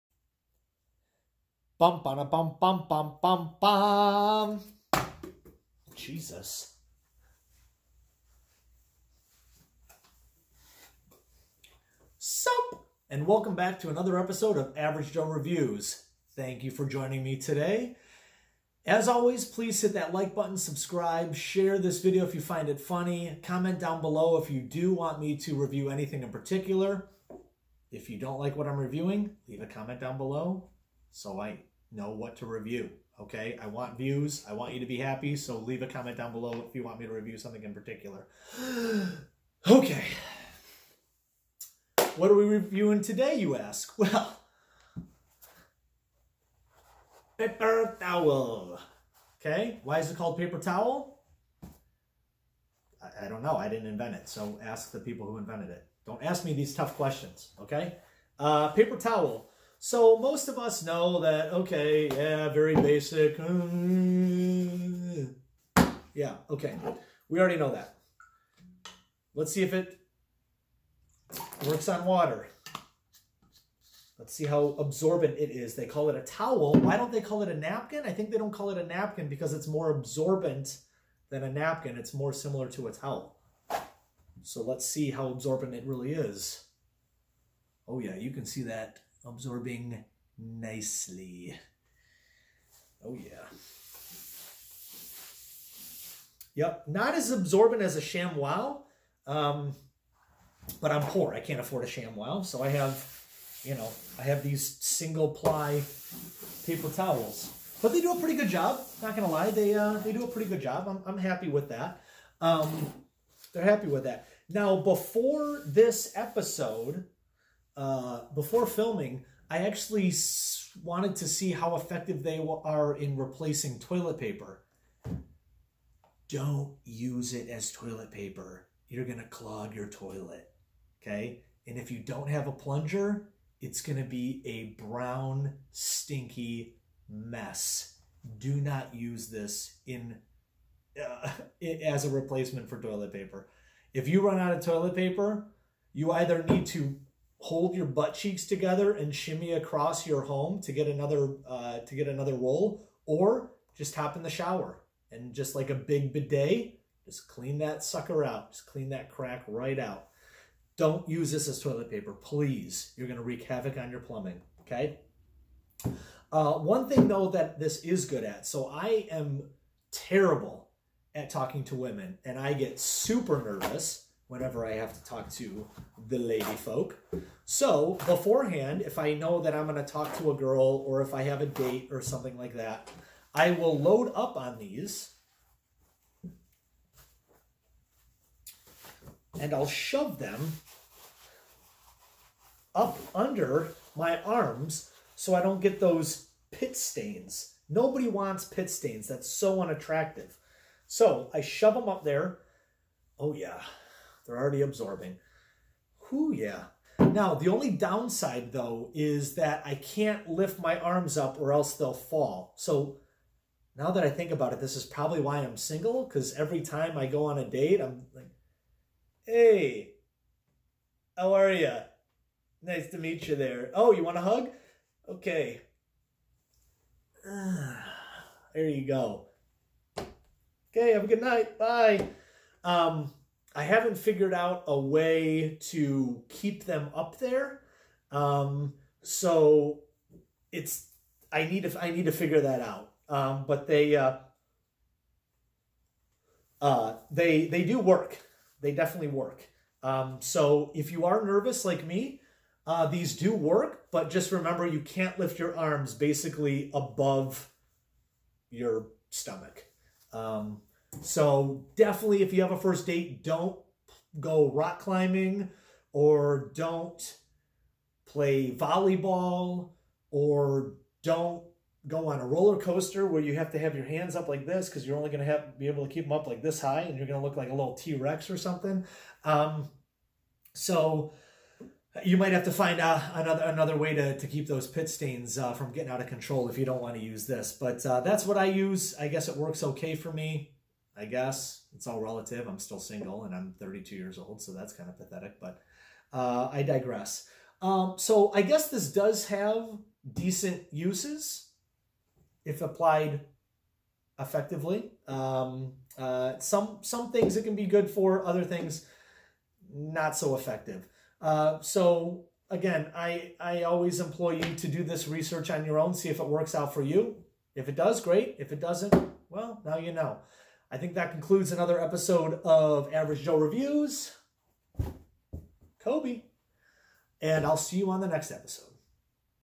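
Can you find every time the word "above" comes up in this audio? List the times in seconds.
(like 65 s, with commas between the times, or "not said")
256 s.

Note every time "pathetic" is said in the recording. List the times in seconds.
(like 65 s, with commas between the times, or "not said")
294 s.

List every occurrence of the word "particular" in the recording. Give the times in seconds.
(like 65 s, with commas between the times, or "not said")
26 s, 37 s.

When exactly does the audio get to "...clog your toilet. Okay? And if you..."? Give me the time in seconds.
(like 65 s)
129 s.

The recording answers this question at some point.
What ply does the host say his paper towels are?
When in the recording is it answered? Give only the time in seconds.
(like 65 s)
104 s.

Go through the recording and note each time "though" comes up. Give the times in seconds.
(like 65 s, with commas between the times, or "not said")
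167 s, 208 s.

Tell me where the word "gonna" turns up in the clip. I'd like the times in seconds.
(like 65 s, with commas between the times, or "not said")
109 s, 163 s.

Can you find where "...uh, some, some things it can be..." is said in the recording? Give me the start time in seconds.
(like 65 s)
305 s.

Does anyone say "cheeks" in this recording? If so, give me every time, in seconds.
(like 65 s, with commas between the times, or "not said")
148 s.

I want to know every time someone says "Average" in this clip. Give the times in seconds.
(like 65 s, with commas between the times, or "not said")
14 s, 322 s.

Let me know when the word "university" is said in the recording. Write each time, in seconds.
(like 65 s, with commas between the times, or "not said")
not said.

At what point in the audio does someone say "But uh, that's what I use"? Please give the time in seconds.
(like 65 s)
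287 s.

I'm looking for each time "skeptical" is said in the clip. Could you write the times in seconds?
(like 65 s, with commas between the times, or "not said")
not said.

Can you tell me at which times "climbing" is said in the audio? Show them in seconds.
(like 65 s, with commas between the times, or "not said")
264 s.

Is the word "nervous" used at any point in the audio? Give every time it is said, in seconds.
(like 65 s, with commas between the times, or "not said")
173 s, 251 s.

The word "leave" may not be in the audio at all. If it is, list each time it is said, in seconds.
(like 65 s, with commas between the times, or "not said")
29 s, 35 s.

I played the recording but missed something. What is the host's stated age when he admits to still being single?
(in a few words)
32.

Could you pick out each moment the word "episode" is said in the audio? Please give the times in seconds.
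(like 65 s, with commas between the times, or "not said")
14 s, 116 s, 321 s, 328 s.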